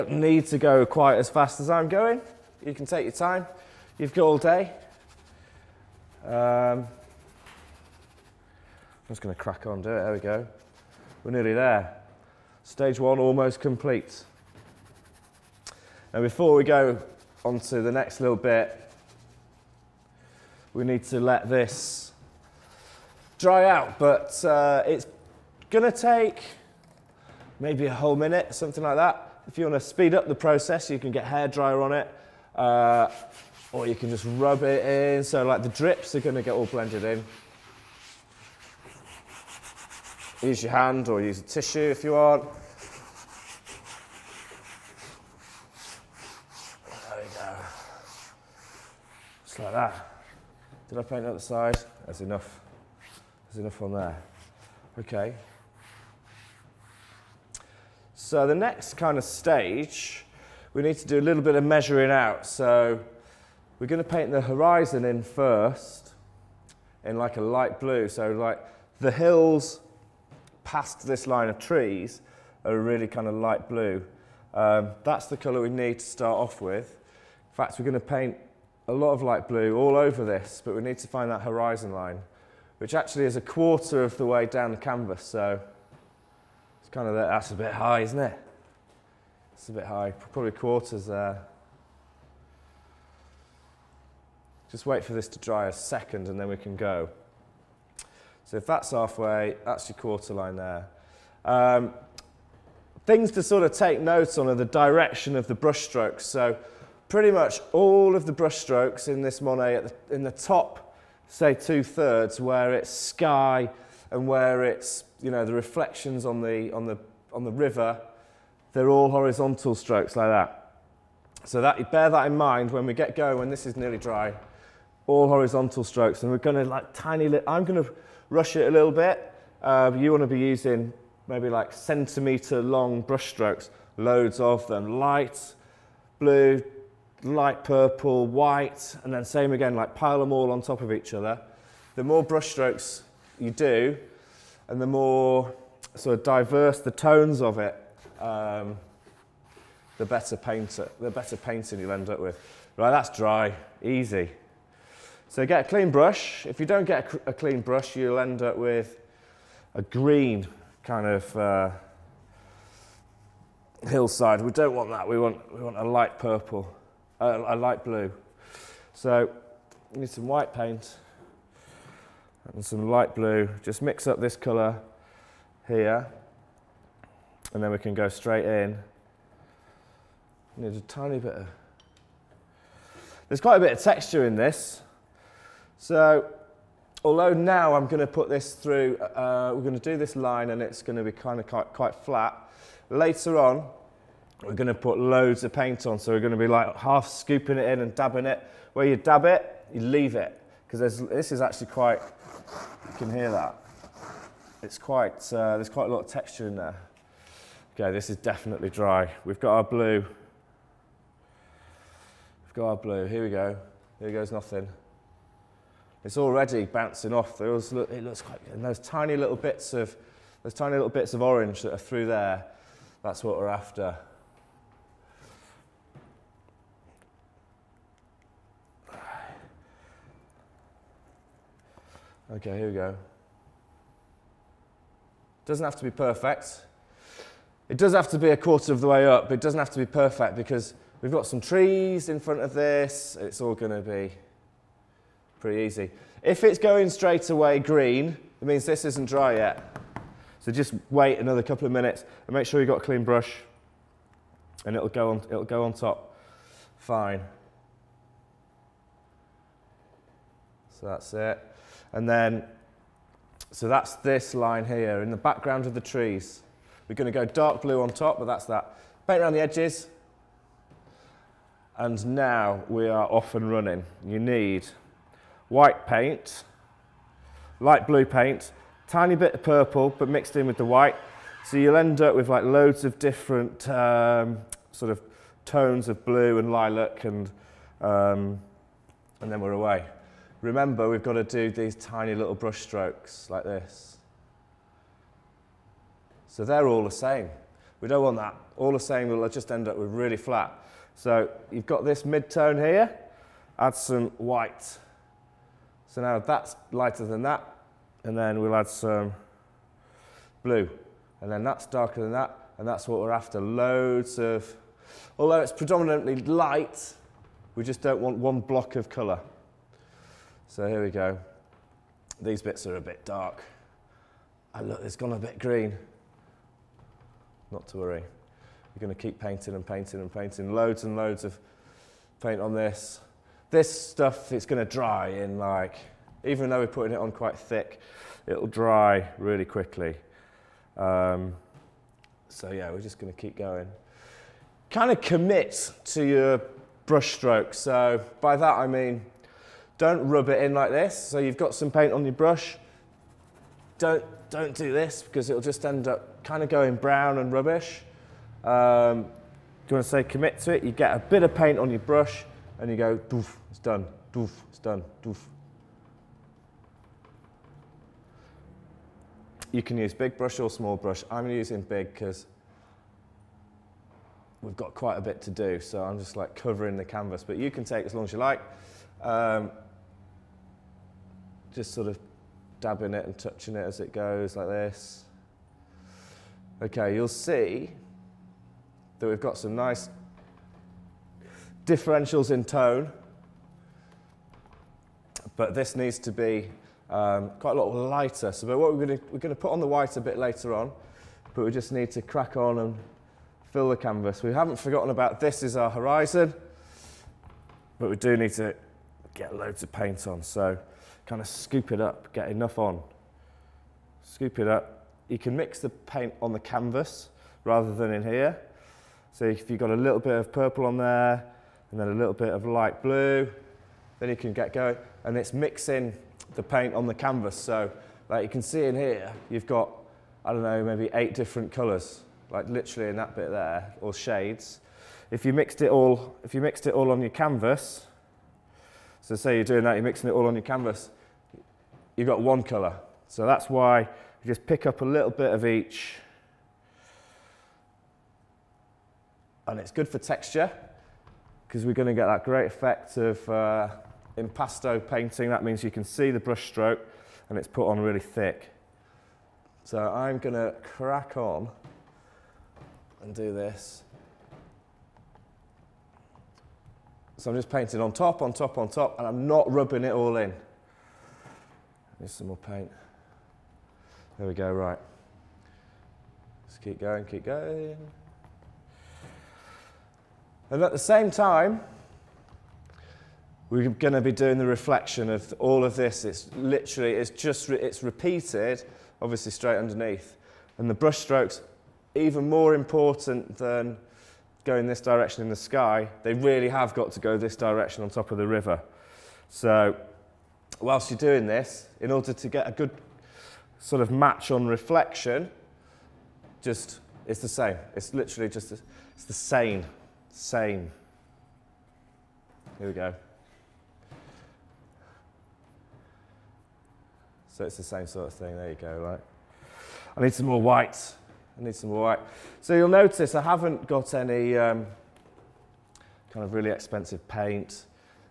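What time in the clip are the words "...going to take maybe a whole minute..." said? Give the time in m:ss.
0:25.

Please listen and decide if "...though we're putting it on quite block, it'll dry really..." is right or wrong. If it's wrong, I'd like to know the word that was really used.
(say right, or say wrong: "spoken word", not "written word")
wrong: "thick", not "block".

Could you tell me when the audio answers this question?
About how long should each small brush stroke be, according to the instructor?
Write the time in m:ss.
2:11.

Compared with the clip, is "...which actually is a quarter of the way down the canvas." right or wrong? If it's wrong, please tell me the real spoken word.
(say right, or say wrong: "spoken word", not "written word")
right.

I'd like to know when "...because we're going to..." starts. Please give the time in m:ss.
7:31.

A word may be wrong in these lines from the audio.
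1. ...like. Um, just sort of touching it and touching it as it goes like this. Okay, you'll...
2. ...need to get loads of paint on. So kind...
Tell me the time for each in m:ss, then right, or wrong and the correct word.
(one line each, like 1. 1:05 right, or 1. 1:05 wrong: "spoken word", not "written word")
1. 6:18 wrong: "dabbing", not "touching"
2. 6:48 right.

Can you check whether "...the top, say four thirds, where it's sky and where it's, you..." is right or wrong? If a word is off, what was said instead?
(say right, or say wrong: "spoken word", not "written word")
wrong: "two", not "four".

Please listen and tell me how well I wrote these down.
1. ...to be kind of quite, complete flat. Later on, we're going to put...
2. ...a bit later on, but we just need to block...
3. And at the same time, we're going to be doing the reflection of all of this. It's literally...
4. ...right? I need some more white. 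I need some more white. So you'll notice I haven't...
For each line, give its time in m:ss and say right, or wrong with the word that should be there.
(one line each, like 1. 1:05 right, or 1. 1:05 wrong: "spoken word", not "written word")
1. 3:10 wrong: "quite", not "complete"
2. 6:39 wrong: "crack", not "block"
3. 8:00 right
4. 8:38 right.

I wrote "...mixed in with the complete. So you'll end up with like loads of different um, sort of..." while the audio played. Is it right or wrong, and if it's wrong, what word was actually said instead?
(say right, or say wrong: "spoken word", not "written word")
wrong: "white", not "complete".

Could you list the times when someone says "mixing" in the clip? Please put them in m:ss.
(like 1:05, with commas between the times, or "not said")
7:05, 7:19.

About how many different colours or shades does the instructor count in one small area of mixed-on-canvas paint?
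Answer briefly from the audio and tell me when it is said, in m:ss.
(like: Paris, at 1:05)
8, at 7:10.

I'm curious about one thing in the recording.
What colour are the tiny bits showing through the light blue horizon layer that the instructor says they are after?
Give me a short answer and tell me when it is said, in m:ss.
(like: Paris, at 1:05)
orange, at 3:41.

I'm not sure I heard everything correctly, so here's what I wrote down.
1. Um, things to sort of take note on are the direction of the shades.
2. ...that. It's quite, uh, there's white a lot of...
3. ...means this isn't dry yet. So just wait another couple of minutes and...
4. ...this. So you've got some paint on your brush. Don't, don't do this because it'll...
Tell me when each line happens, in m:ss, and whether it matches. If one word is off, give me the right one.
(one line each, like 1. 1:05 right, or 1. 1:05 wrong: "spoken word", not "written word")
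1. 1:41 wrong: "brushstrokes", not "shades"
2. 3:23 wrong: "quite", not "white"
3. 4:08 right
4. 5:50 right.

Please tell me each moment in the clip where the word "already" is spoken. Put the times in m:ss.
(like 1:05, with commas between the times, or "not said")
3:36.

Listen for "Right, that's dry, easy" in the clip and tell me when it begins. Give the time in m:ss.
2:32.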